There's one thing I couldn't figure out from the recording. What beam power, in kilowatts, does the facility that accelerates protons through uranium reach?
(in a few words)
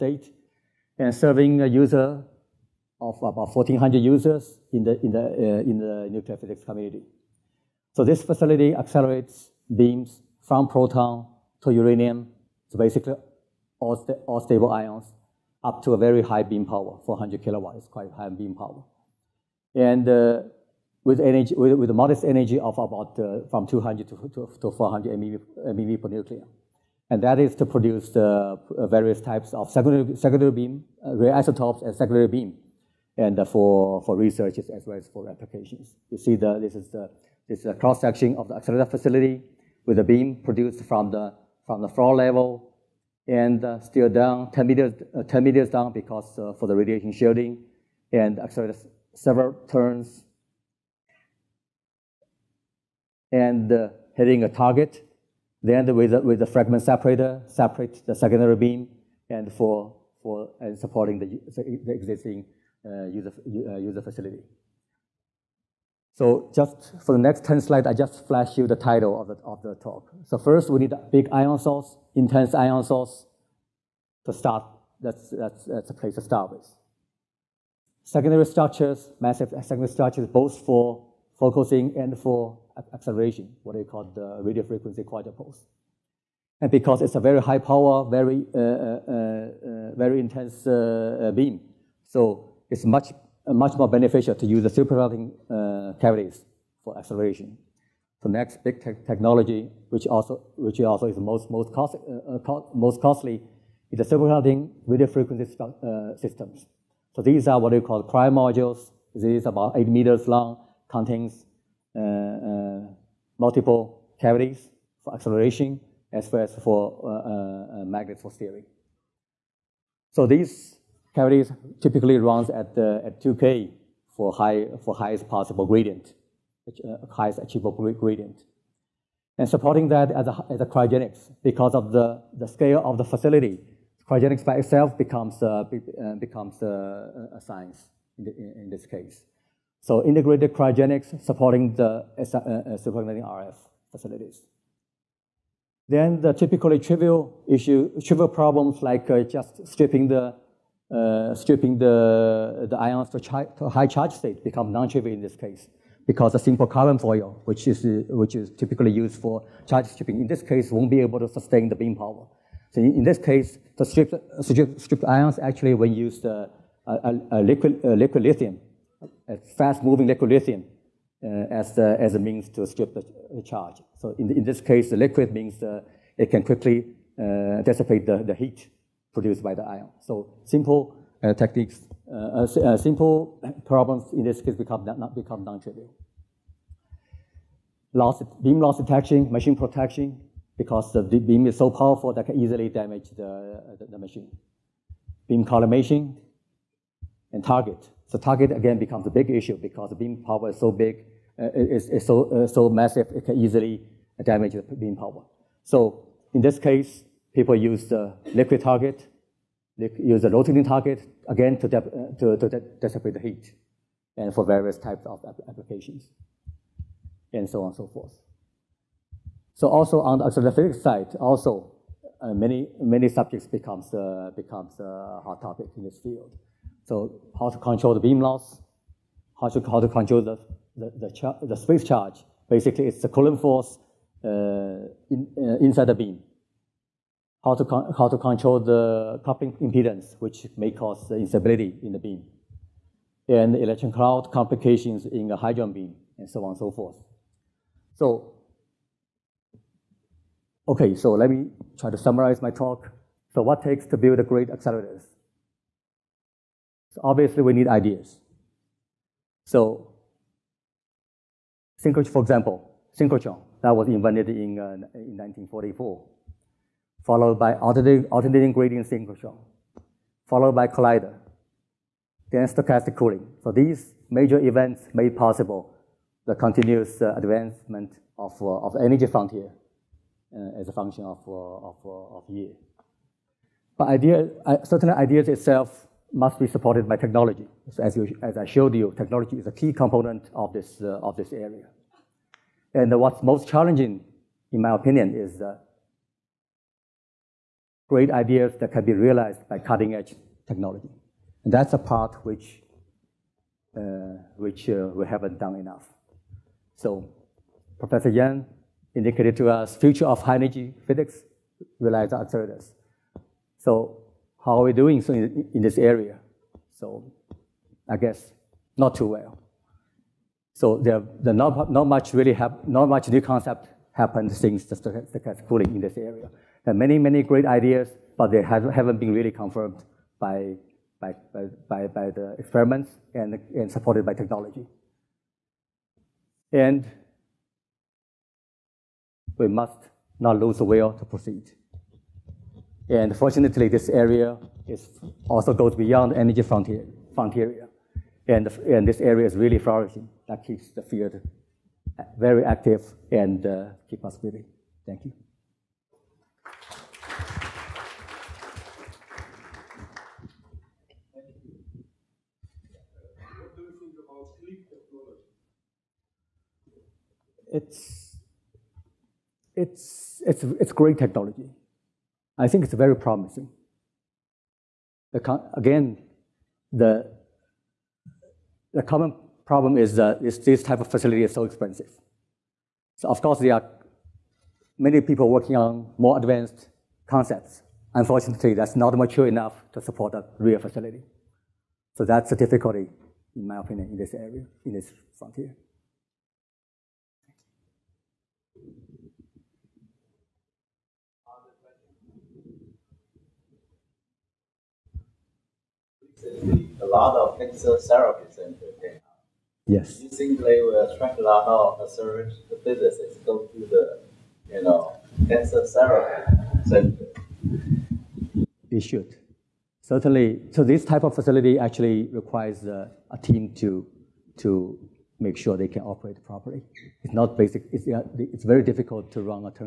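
400 kilowatts.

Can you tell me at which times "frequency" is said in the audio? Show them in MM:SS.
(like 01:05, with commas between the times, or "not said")
01:24, 01:45.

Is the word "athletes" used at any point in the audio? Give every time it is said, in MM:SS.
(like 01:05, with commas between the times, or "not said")
not said.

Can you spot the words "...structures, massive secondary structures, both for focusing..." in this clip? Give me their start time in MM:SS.
01:18.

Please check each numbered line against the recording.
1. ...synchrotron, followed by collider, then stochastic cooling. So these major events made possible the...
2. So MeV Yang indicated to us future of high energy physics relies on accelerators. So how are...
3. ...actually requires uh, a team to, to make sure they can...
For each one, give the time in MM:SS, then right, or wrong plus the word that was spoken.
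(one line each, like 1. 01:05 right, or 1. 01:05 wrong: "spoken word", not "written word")
1. 04:28 right
2. 05:06 wrong: "Professor", not "MeV"
3. 07:01 right.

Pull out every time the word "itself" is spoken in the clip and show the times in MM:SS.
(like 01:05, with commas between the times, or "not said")
02:14, 04:45.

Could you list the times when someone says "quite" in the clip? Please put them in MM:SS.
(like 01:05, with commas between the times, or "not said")
00:17.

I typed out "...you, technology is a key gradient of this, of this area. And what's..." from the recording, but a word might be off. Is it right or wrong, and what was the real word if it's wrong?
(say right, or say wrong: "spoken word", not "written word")
wrong: "component", not "gradient".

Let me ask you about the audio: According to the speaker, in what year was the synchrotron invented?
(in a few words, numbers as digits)
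1944.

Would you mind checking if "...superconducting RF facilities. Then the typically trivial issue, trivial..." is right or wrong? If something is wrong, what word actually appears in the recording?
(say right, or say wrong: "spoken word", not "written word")
right.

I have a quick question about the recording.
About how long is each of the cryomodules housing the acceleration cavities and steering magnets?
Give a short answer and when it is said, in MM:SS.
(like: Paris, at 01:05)
8 meters, at 01:49.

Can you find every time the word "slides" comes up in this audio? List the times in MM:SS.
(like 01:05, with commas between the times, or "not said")
01:07.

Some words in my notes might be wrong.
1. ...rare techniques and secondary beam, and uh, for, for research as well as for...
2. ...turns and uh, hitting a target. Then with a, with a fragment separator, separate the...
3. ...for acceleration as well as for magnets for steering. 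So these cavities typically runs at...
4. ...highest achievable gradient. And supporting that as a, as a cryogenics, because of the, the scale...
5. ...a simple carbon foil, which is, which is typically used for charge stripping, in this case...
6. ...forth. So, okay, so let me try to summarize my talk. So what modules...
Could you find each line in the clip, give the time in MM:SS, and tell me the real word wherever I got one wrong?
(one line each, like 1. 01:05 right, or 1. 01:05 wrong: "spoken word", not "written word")
1. 00:31 wrong: "isotopes", not "techniques"
2. 00:49 right
3. 01:55 right
4. 02:07 right
5. 02:36 right
6. 04:06 wrong: "takes", not "modules".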